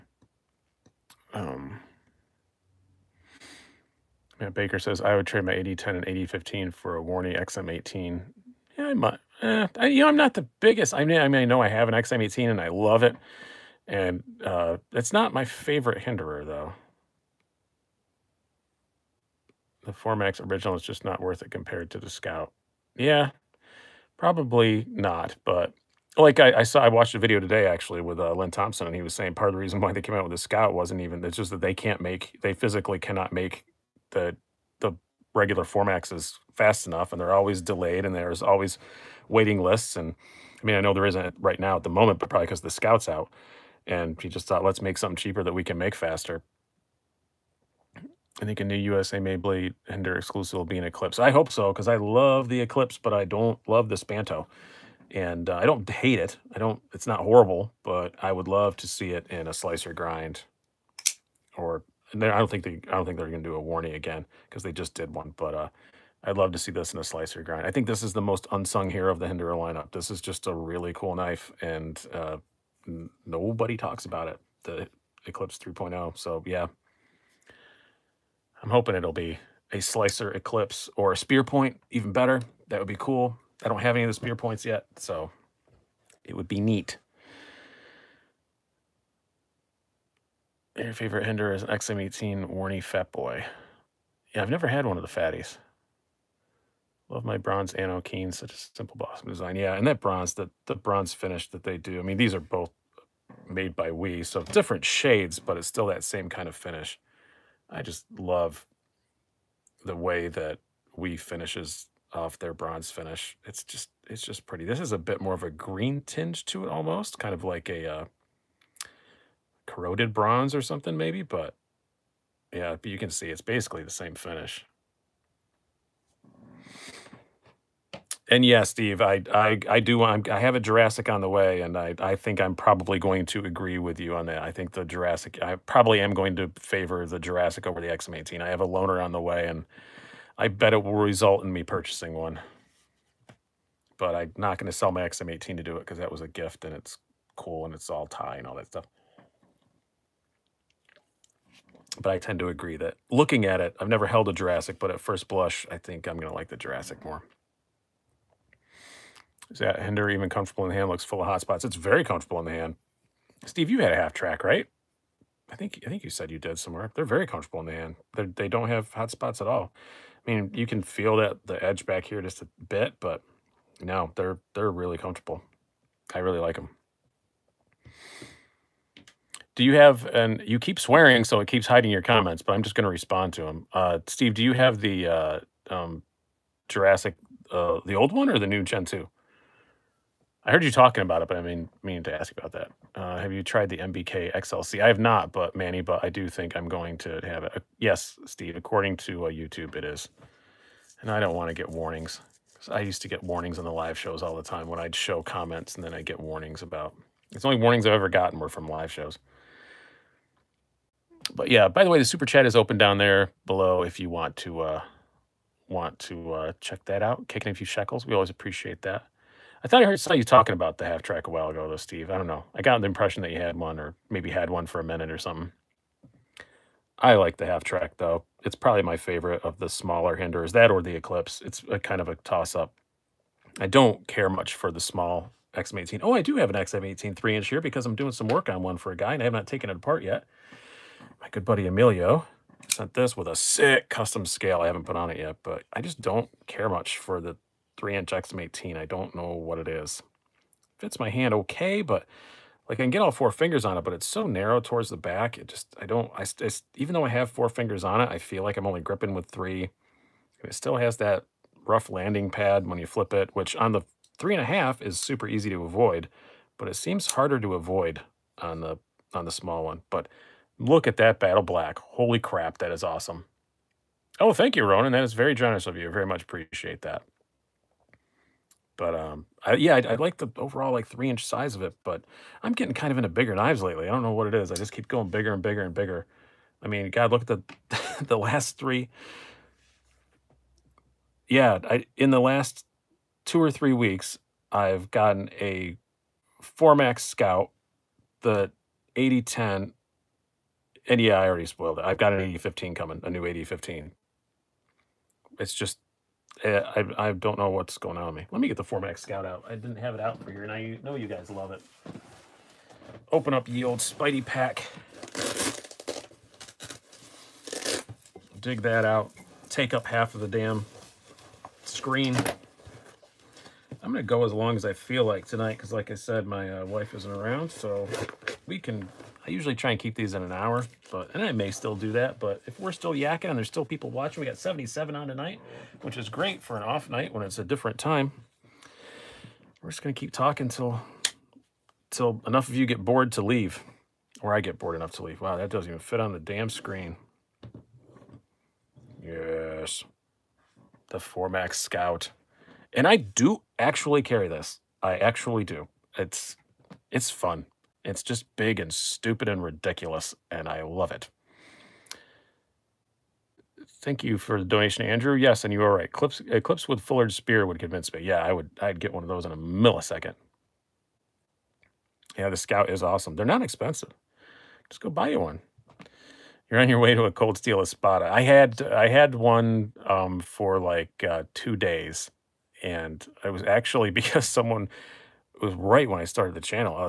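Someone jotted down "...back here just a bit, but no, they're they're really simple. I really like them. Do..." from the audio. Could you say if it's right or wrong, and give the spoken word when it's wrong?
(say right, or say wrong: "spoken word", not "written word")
wrong: "comfortable", not "simple".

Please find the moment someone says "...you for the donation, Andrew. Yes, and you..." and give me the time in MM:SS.
06:04.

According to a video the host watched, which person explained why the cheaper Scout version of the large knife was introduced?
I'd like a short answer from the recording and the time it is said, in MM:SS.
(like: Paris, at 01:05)
Lynn Thompson, at 00:28.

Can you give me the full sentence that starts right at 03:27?
It's only warnings I've ever gotten were from live shows.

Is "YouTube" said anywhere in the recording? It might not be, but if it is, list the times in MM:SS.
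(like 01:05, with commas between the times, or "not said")
03:19.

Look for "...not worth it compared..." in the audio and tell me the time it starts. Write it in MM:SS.
00:21.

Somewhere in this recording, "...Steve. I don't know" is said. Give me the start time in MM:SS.
03:41.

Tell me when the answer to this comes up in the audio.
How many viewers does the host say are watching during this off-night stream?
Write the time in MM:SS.
05:34.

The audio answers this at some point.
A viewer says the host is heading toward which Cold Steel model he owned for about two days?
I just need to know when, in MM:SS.
06:17.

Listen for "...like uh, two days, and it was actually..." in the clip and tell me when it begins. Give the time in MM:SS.
06:20.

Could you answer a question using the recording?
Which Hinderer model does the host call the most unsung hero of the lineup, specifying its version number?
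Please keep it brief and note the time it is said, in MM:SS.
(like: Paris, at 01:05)
Eclipse 3.0, at 01:14.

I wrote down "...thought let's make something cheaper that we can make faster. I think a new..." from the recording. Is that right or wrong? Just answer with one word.
right.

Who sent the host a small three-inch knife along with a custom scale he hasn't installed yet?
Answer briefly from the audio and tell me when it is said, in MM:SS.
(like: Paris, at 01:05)
Emilio, at 04:01.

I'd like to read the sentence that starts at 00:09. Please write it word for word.
Eh, I, you know, I'm not the biggest.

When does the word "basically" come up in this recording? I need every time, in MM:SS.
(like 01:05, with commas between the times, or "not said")
02:03.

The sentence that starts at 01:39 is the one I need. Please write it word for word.
Yeah, and that bronze, the, the bronze finish that they do.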